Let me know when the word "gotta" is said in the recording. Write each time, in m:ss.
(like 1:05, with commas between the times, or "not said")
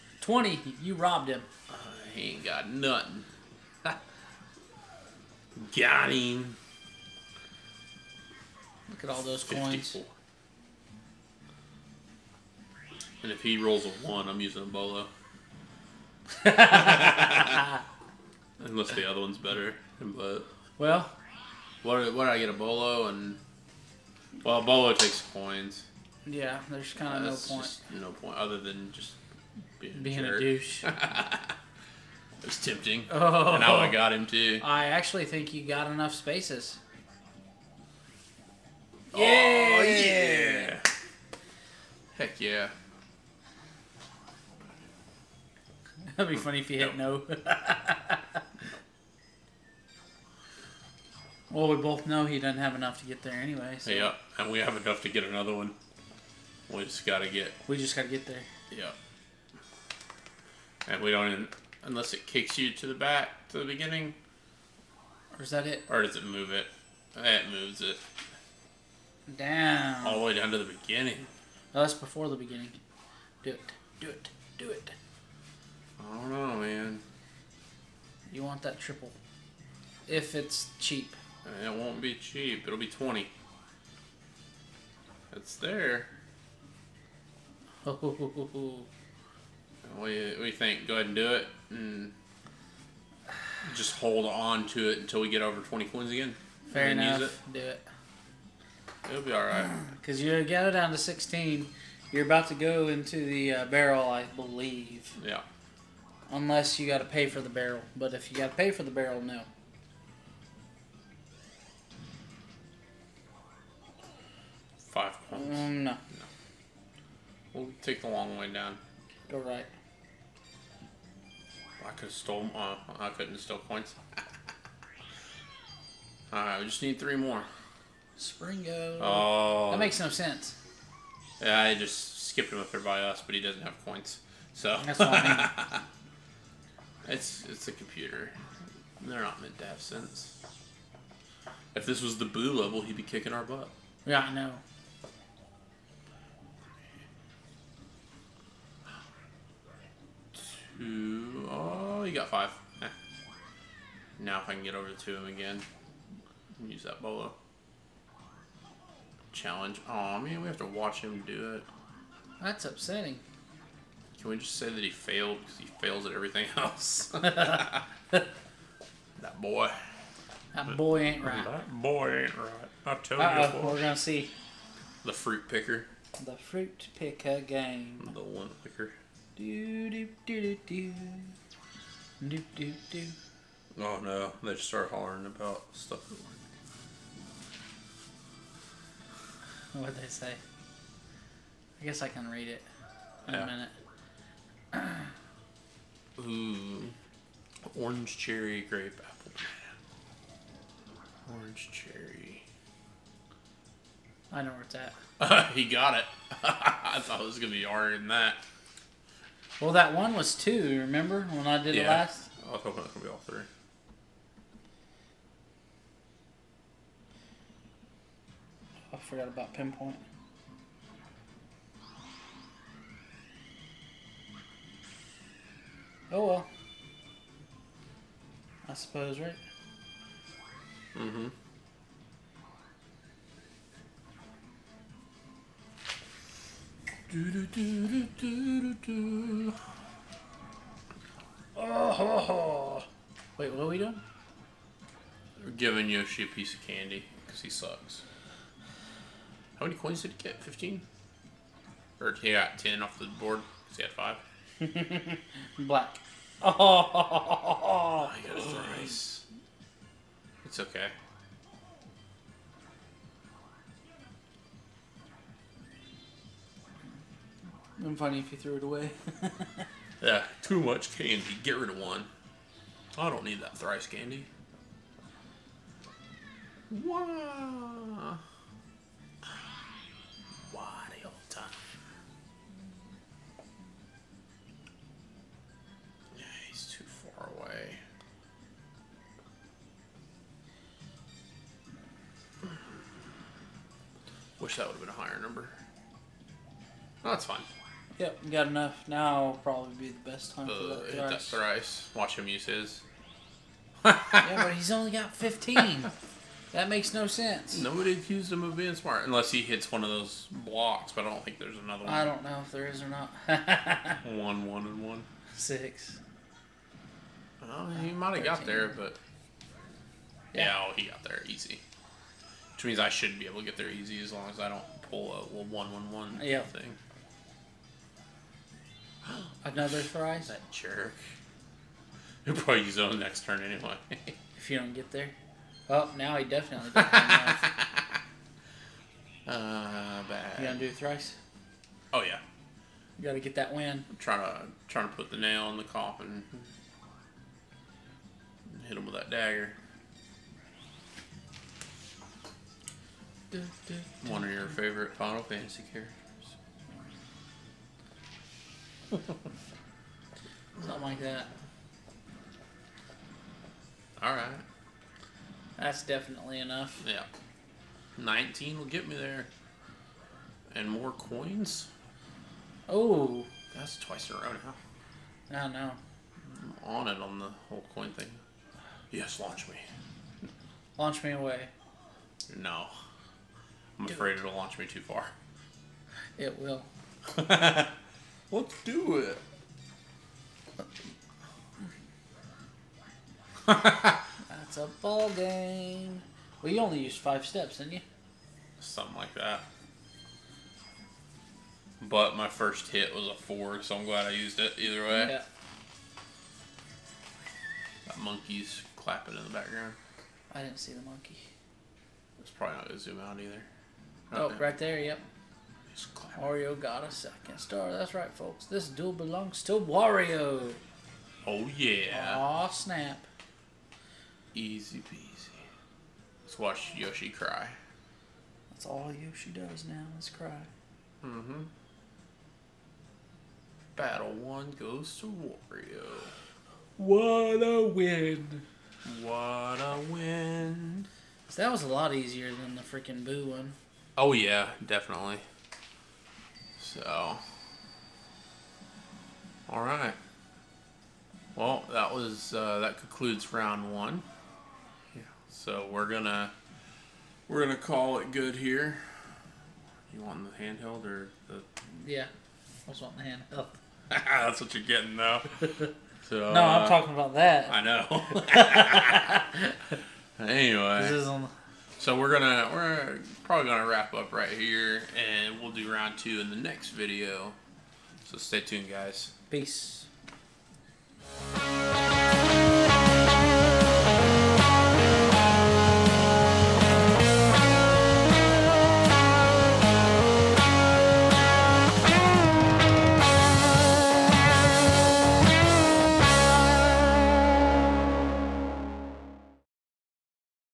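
5:43.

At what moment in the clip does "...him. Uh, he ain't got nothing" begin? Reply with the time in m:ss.
0:01.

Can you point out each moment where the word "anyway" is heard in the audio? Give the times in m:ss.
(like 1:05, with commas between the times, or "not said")
0:53, 5:33, 7:50.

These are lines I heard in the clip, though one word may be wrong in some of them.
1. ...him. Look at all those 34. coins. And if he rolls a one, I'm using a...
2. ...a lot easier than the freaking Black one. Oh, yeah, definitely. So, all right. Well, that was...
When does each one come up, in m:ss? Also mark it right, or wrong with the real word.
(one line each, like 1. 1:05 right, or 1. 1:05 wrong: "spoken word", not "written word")
1. 0:06 wrong: "54", not "34"
2. 7:21 wrong: "Boo", not "Black".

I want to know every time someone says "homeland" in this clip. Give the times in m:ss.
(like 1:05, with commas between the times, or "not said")
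not said.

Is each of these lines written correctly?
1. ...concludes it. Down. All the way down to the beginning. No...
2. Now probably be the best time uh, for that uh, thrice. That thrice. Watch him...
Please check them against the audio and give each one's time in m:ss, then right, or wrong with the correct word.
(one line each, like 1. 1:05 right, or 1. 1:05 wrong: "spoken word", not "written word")
1. 1:07 wrong: "moves", not "concludes"
2. 4:58 right.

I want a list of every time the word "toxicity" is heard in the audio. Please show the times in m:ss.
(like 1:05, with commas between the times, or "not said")
not said.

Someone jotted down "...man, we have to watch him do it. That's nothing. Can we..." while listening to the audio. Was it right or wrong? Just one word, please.
wrong.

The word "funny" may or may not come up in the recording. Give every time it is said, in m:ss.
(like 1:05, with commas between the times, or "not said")
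0:46, 4:27.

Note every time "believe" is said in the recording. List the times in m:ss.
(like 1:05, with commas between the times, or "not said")
1:44.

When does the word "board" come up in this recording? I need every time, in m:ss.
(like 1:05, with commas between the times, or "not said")
4:13.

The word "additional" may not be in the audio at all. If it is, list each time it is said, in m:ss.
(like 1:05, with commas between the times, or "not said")
not said.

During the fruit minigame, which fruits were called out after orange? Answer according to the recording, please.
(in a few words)
cherry grape apple.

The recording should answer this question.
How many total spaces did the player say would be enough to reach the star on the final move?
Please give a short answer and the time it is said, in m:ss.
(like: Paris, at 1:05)
19, at 6:07.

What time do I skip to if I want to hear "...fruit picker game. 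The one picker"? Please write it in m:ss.
2:56.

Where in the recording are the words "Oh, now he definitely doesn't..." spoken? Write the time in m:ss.
5:35.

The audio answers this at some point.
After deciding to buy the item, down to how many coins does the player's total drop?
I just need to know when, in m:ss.
1:40.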